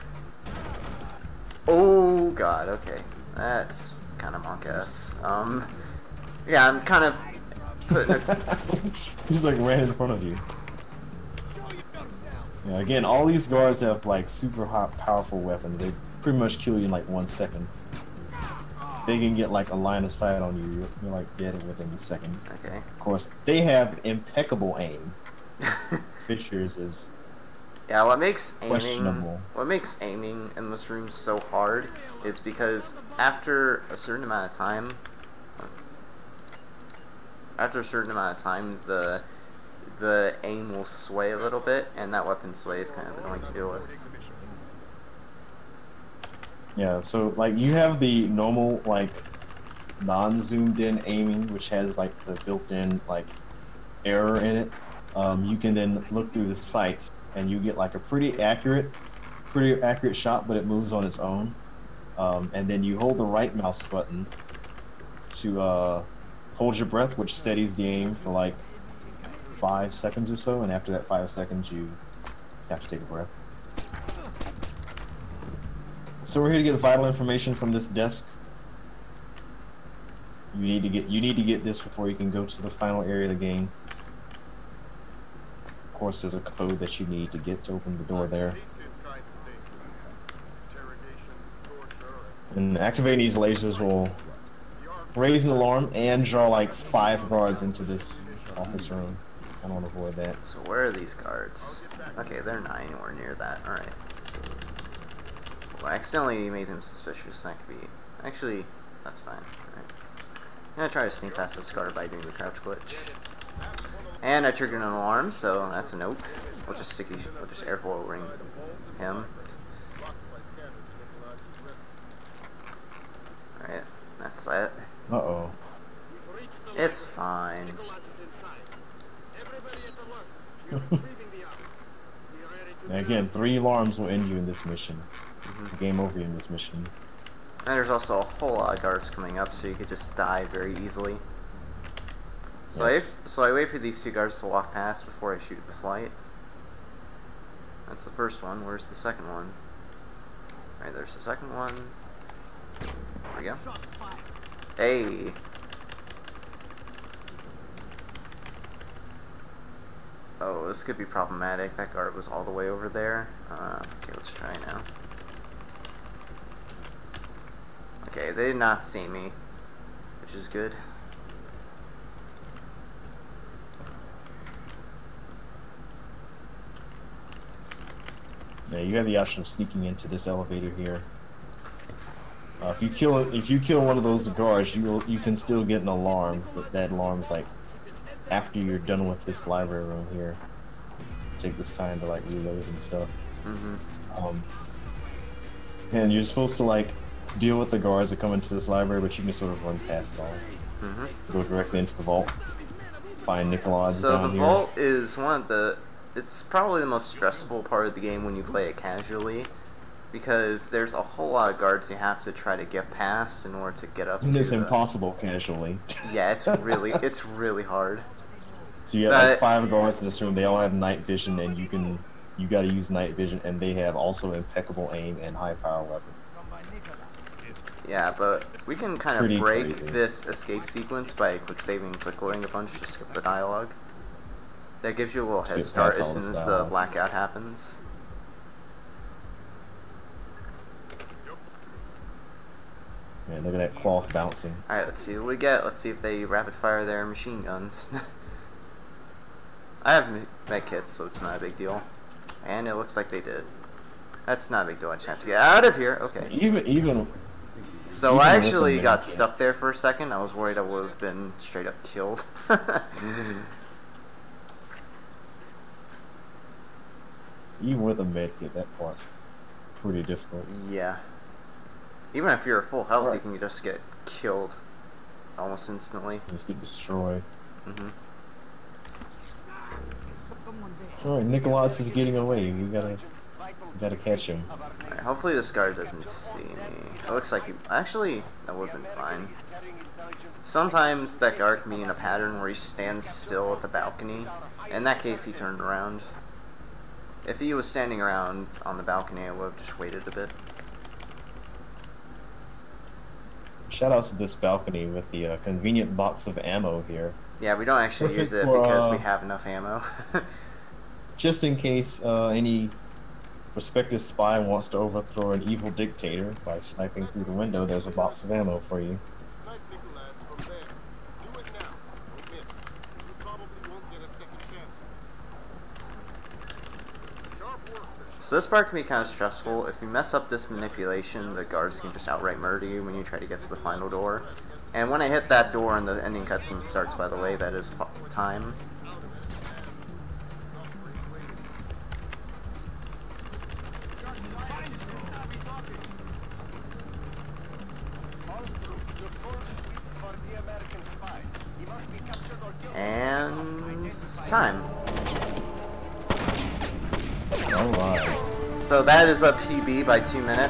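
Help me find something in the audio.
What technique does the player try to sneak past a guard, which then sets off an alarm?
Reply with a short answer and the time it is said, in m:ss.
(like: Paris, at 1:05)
Crouch glitch, at 1:52.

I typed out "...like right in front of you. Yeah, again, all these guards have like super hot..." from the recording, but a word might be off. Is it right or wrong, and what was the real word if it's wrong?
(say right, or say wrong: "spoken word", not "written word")
right.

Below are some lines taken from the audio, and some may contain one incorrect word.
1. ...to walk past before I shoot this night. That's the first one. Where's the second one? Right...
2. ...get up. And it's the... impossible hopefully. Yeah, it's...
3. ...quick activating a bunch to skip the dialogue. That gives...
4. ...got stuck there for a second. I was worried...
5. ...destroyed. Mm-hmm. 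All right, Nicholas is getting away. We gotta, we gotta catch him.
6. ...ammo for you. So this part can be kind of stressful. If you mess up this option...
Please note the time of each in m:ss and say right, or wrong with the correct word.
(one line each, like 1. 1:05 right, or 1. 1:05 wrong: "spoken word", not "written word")
1. 2:24 wrong: "light", not "night"
2. 3:33 wrong: "casually", not "hopefully"
3. 3:51 wrong: "loading", not "activating"
4. 4:18 right
5. 4:36 right
6. 5:18 wrong: "manipulation", not "option".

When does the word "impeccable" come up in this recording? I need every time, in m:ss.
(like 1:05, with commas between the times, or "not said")
0:24, 3:44.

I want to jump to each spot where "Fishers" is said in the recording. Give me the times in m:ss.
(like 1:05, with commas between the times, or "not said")
0:26.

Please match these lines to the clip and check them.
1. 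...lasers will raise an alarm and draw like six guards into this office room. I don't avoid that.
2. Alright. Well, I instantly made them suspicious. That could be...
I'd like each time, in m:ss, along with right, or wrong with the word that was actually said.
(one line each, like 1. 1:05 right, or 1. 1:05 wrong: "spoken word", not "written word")
1. 1:33 wrong: "five", not "six"
2. 1:43 wrong: "accidentally", not "instantly".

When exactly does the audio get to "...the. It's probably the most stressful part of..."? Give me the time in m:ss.
3:25.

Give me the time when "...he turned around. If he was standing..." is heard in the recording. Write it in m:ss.
4:55.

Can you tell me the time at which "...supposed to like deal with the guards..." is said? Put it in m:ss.
3:16.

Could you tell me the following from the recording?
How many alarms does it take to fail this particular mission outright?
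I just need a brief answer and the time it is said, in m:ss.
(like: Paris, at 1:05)
3, at 2:13.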